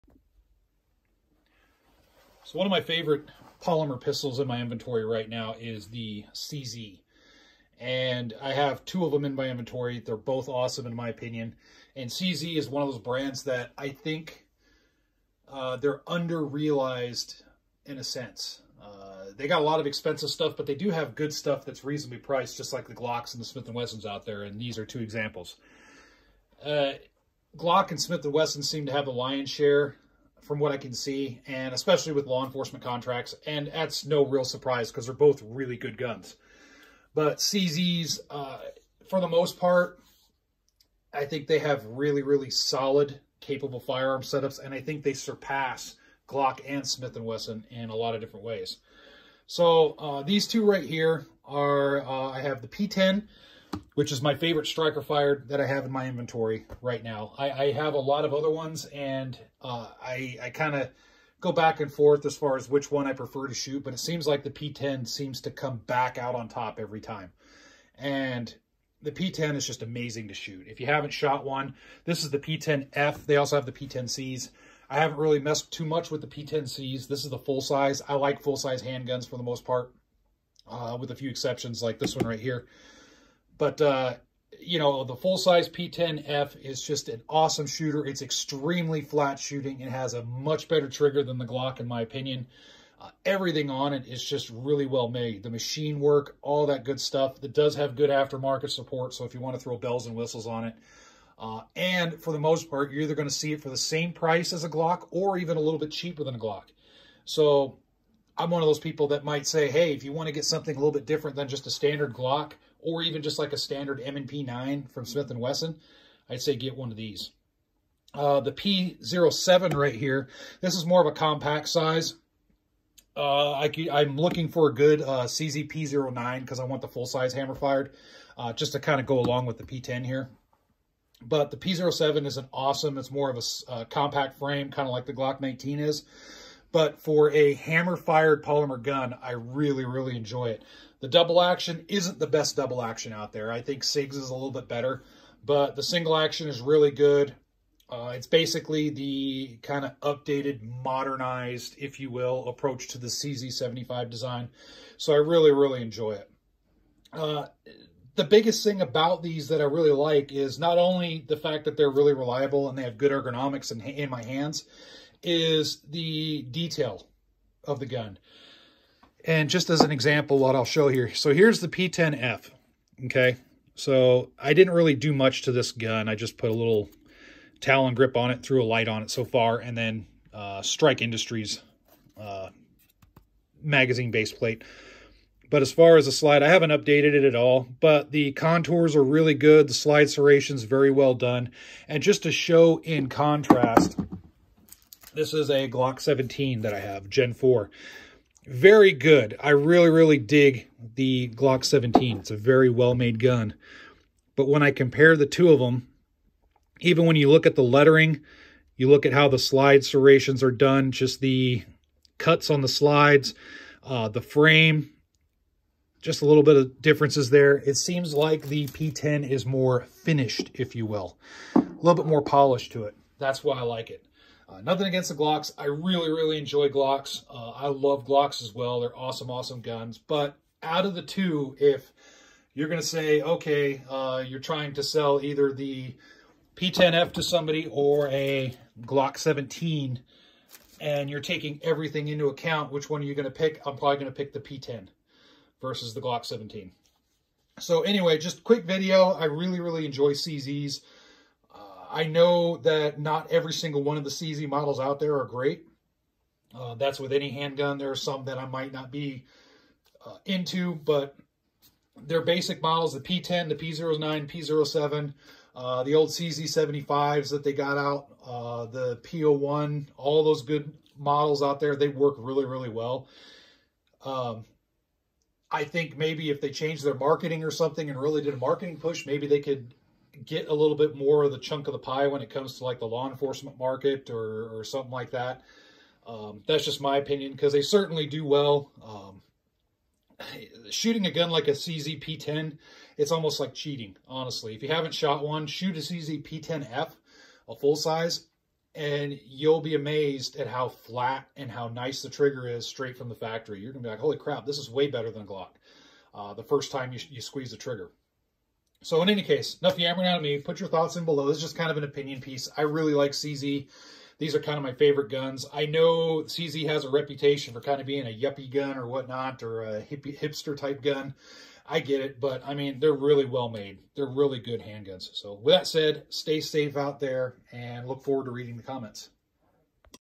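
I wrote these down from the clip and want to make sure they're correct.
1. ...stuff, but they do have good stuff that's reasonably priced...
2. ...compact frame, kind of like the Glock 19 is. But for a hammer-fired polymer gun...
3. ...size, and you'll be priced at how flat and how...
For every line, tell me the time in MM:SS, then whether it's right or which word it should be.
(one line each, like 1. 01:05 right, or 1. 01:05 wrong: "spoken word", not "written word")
1. 00:20 right
2. 02:13 right
3. 04:57 wrong: "amazed", not "priced".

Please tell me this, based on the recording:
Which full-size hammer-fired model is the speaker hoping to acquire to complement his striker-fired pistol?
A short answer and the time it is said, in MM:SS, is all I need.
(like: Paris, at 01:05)
CZ P09, at 02:05.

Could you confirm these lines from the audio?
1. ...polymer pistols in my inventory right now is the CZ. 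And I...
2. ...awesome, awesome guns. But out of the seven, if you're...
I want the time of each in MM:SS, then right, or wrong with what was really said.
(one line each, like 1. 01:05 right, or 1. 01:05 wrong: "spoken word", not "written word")
1. 00:03 right
2. 03:48 wrong: "two", not "seven".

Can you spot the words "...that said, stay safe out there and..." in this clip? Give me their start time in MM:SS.
05:25.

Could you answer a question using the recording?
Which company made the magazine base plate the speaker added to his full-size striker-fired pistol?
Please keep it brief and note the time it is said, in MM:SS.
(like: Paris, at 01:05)
Strike Industries, at 03:00.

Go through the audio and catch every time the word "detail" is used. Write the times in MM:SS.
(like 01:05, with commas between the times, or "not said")
02:46.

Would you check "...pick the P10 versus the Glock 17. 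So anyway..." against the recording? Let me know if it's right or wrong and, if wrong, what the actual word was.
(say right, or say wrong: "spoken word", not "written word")
right.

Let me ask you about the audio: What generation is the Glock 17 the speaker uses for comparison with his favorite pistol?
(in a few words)
Gen 4.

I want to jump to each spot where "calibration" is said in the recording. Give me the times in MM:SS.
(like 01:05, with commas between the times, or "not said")
not said.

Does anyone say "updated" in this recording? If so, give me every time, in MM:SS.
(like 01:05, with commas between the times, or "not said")
02:29, 03:06.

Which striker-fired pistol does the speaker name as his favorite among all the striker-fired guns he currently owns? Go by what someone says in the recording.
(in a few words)
P10.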